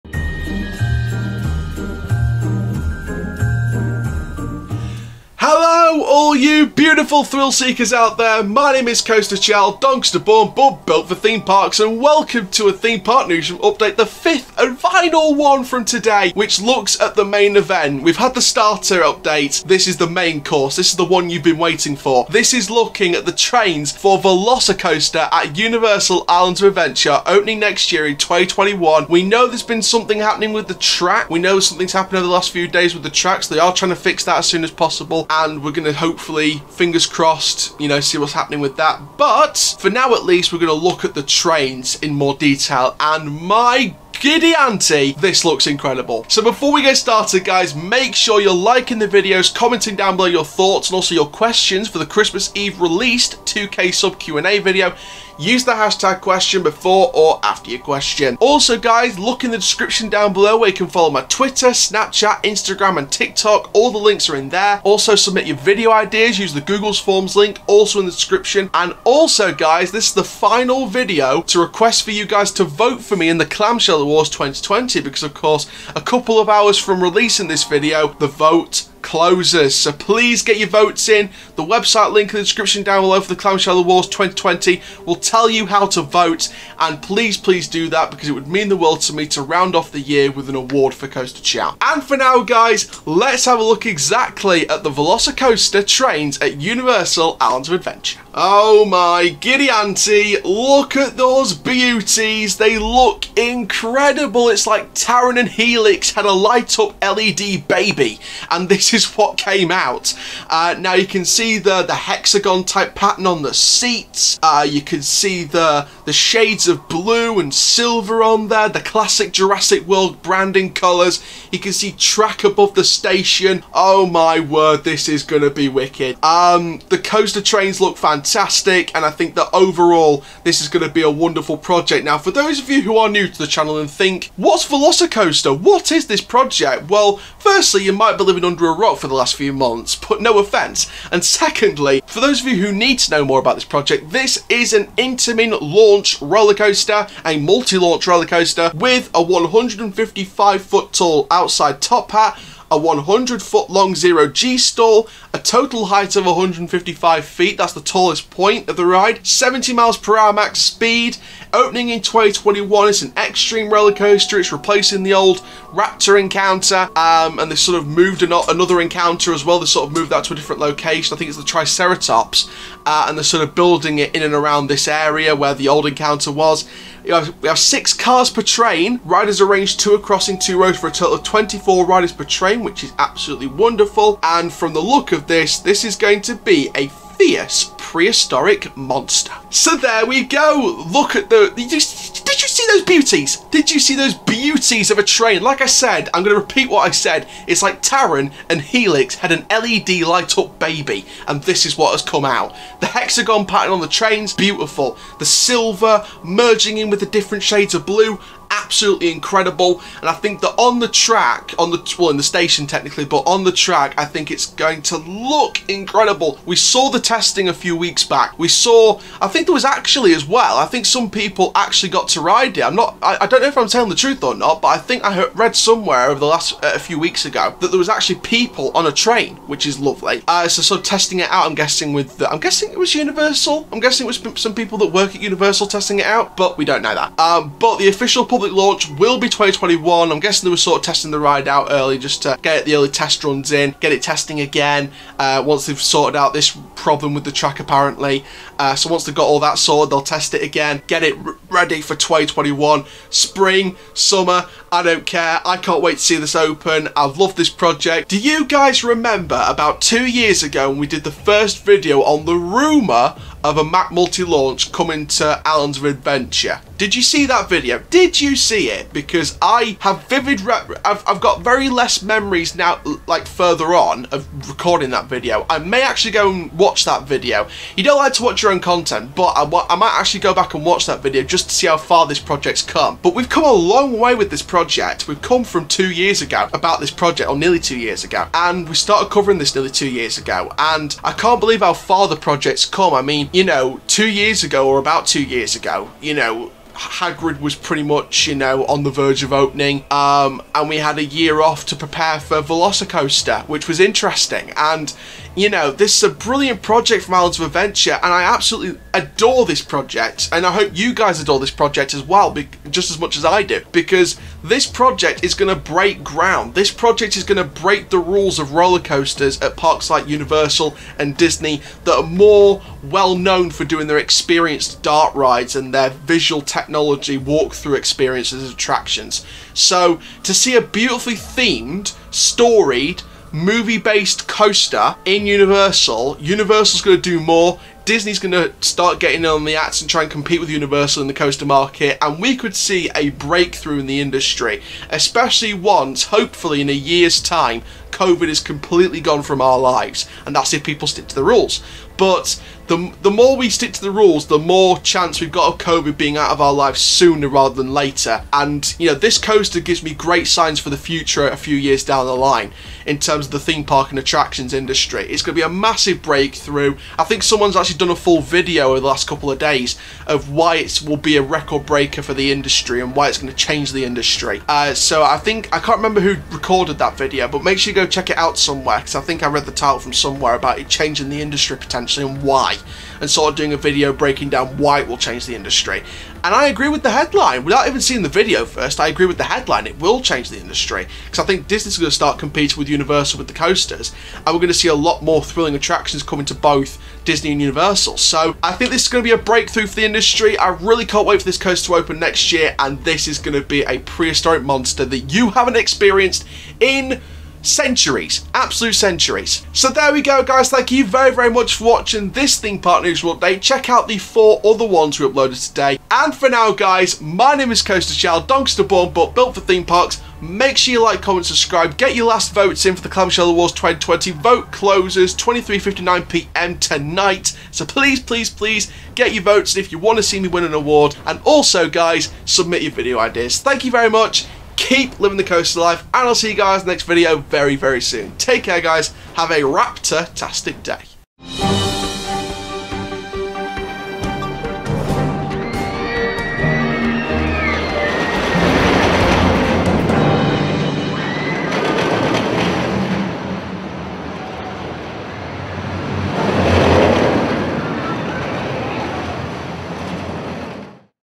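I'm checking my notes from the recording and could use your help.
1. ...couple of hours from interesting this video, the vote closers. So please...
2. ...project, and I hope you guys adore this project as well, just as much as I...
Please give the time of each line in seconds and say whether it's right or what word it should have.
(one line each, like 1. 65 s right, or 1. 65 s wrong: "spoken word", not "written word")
1. 76 s wrong: "releasing", not "interesting"
2. 309 s right.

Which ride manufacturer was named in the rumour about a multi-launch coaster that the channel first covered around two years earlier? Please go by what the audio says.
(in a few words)
Mack.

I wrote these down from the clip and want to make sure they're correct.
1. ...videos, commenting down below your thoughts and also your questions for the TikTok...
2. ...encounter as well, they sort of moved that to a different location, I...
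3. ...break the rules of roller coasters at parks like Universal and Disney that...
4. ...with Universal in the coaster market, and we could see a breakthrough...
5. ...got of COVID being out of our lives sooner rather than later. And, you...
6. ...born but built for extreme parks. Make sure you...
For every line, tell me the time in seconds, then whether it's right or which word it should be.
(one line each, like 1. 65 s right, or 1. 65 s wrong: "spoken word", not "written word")
1. 49 s wrong: "Christmas", not "TikTok"
2. 168 s right
3. 317 s right
4. 340 s right
5. 355 s right
6. 418 s wrong: "theme", not "extreme".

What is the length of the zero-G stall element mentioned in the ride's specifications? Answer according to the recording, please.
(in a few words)
100 feet.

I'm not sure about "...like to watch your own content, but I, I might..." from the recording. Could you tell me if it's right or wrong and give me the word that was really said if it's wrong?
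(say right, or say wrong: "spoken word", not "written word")
right.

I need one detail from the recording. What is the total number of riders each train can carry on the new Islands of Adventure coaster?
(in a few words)
24.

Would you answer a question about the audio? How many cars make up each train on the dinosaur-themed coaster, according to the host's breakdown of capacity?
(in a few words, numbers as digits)
6.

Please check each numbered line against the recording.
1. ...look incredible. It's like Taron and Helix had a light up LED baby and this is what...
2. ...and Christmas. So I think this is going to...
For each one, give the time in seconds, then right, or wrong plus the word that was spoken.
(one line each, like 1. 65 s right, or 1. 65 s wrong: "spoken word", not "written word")
1. 102 s right
2. 397 s wrong: "Universal", not "Christmas".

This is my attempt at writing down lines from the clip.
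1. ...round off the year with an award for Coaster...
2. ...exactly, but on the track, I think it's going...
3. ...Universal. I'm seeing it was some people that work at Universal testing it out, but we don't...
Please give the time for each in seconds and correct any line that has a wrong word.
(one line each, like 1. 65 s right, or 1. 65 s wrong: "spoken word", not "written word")
1. 89 s right
2. 212 s wrong: "technically", not "exactly"
3. 232 s wrong: "guessing", not "seeing".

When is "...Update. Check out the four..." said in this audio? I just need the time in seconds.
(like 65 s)
413 s.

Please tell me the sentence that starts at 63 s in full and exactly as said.
All the links are in there.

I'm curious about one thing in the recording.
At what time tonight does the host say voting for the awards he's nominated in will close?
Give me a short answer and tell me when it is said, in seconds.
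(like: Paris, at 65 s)
23:59, at 425 s.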